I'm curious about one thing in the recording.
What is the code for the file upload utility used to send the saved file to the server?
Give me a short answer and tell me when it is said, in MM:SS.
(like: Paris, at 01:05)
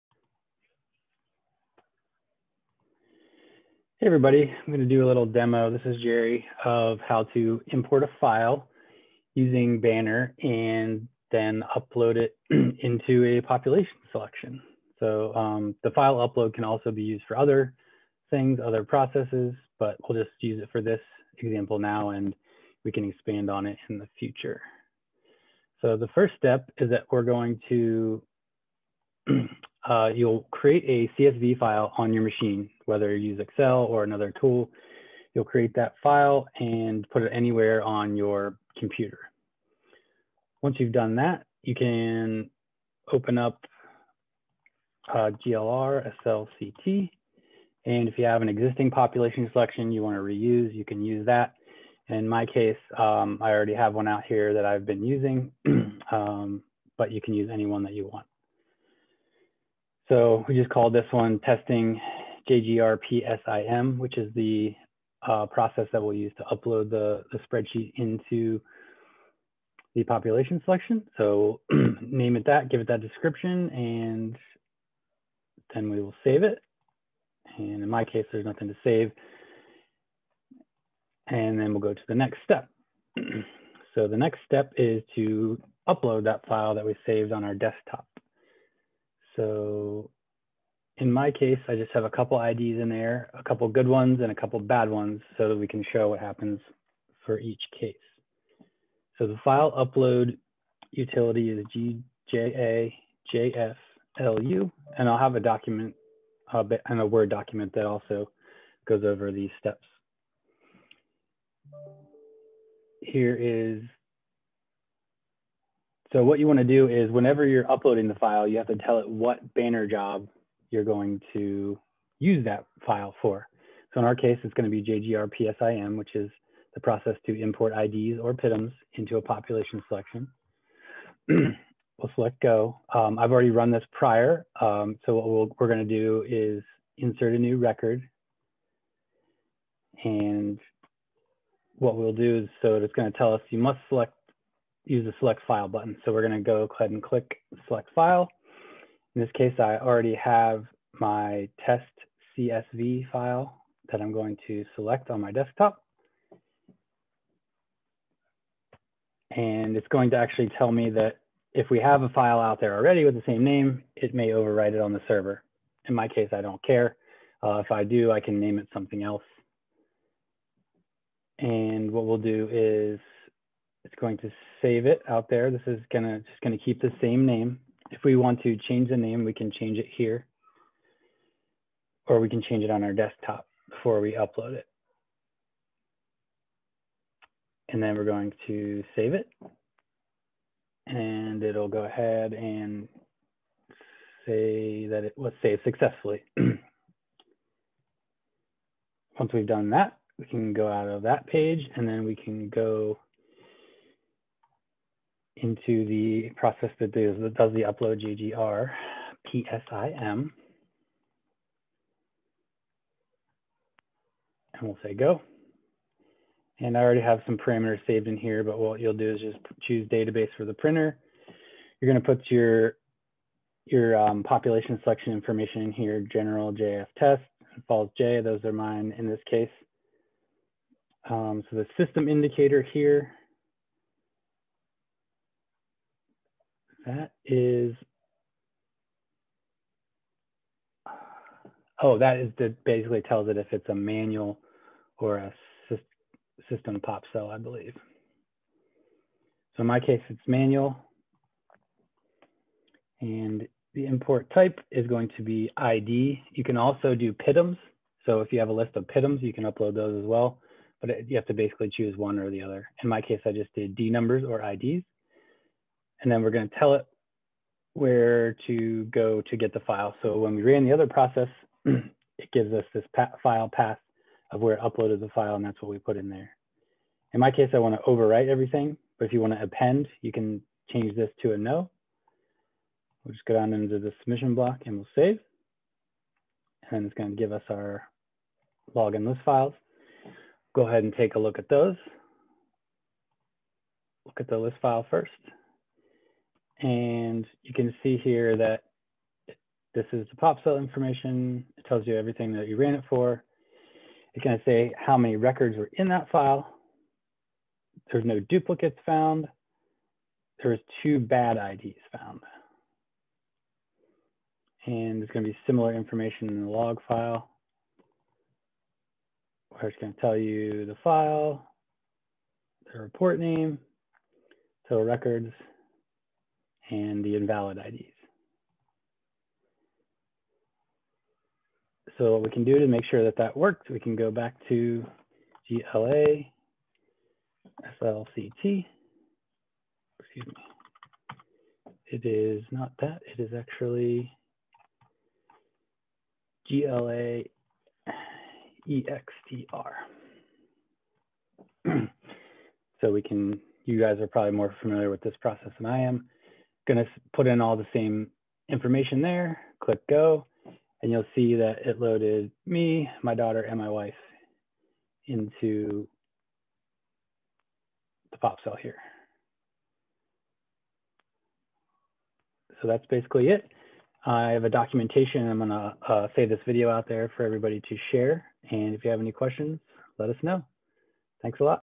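GJAJFLU, at 01:42.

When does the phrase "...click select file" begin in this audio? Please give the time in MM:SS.
02:27.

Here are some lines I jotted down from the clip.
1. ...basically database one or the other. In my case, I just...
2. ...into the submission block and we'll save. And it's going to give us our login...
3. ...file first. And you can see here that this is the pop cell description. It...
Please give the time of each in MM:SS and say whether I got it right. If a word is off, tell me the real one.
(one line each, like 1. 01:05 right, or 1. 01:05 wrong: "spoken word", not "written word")
1. 04:21 wrong: "choose", not "database"
2. 04:43 right
3. 04:54 wrong: "information", not "description".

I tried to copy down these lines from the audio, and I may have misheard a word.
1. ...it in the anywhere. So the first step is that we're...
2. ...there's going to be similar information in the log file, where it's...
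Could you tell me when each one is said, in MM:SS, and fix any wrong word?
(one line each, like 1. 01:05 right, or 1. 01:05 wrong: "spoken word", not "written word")
1. 00:23 wrong: "future", not "anywhere"
2. 05:15 right.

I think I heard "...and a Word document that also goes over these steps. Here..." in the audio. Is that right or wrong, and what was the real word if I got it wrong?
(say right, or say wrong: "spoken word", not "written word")
right.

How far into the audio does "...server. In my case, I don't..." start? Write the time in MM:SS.
02:45.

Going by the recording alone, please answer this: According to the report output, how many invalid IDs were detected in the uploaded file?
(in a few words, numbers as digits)
2.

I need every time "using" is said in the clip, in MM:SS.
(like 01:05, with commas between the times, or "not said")
00:09, 00:55.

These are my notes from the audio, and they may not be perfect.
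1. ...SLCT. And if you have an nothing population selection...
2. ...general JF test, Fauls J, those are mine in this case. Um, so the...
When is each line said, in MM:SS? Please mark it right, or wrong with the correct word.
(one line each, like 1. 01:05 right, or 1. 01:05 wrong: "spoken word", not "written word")
1. 00:46 wrong: "existing", not "nothing"
2. 03:46 right.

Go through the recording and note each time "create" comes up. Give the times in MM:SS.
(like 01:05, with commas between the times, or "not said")
00:30, 00:35.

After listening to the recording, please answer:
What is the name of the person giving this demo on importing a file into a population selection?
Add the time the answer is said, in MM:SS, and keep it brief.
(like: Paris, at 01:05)
Jerry, at 00:06.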